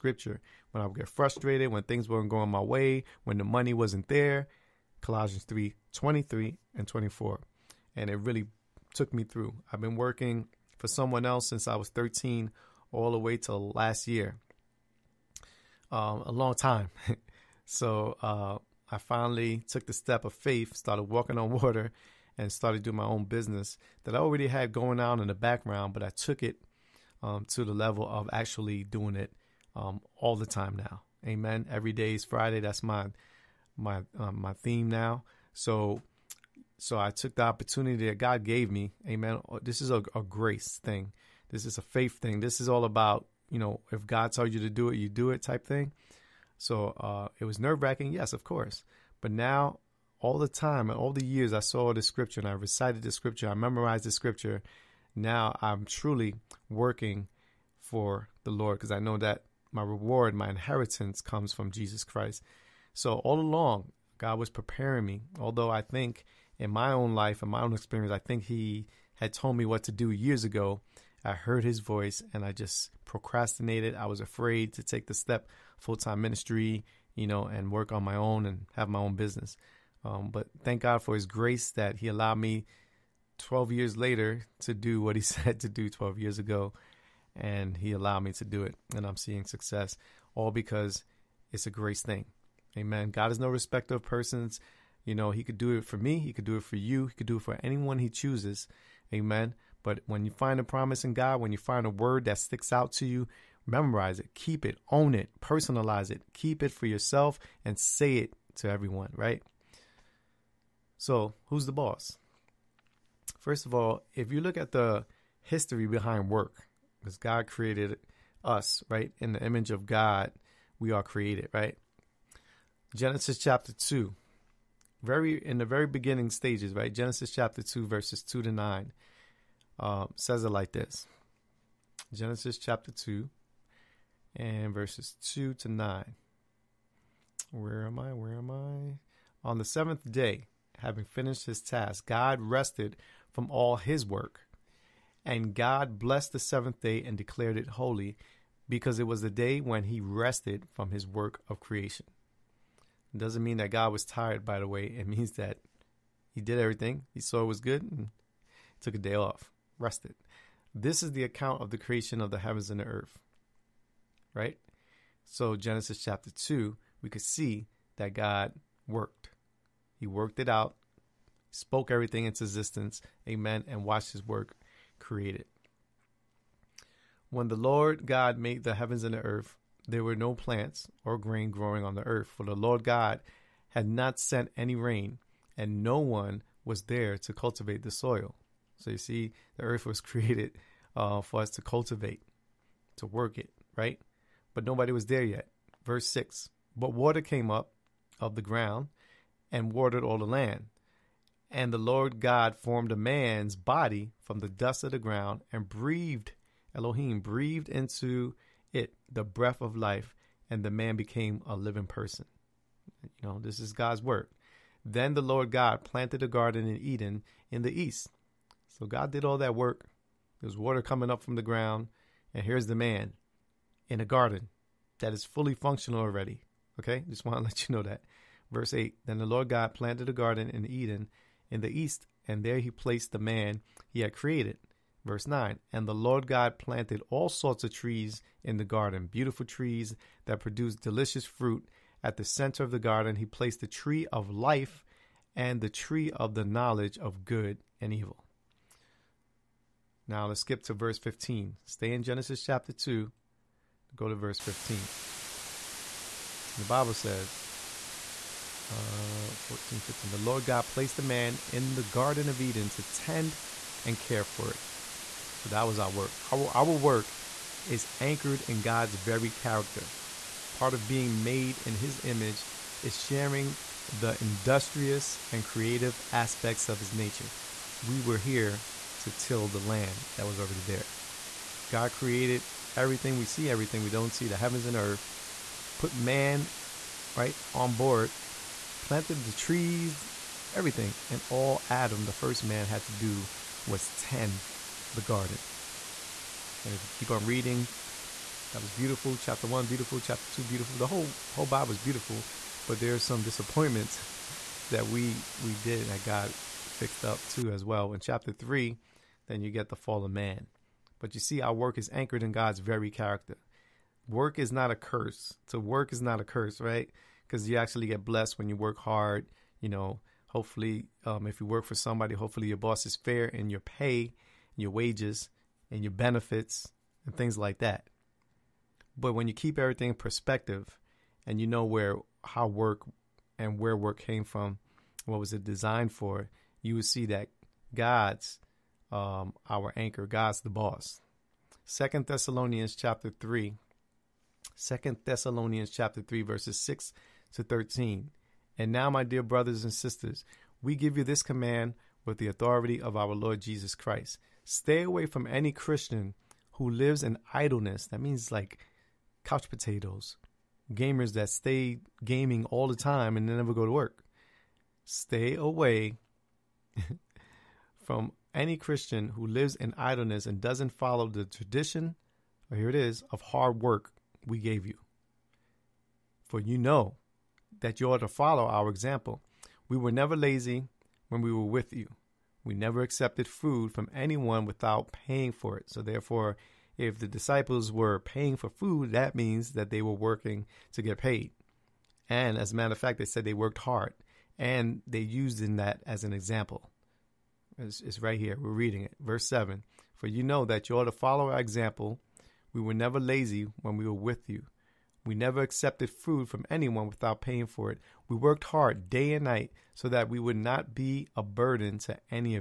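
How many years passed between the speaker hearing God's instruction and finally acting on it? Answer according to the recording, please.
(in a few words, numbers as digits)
12 years.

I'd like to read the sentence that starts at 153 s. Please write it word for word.
It doesn't mean that God was tired, by the way.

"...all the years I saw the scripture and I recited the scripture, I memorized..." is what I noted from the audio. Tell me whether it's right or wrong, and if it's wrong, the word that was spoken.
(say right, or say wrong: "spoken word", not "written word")
right.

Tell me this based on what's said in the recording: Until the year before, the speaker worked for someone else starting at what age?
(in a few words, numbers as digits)
13.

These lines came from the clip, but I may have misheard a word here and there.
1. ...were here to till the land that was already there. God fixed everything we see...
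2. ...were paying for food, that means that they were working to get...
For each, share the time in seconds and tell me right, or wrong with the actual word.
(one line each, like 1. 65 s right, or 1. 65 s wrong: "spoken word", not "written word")
1. 277 s wrong: "created", not "fixed"
2. 387 s right.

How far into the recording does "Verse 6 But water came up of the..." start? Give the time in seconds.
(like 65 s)
195 s.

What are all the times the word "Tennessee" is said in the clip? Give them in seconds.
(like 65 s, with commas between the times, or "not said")
not said.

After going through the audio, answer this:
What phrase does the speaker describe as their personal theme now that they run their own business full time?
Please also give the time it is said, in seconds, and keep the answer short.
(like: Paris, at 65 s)
Every day is Friday, at 31 s.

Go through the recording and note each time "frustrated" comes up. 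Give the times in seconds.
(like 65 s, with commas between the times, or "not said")
1 s.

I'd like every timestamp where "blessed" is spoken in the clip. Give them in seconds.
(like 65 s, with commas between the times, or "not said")
145 s, 318 s.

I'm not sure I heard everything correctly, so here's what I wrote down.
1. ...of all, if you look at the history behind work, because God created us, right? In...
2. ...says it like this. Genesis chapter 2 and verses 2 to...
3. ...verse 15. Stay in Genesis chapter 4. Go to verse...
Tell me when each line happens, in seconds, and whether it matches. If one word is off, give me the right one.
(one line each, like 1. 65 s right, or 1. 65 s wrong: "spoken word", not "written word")
1. 113 s right
2. 130 s right
3. 250 s wrong: "2", not "4".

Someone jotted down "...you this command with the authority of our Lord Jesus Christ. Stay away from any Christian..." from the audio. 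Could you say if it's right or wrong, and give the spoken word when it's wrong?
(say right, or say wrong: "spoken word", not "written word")
right.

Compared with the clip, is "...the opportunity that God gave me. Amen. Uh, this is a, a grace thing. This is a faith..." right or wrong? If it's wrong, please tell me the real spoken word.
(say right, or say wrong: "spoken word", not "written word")
right.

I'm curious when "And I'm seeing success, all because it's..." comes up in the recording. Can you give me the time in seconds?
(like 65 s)
88 s.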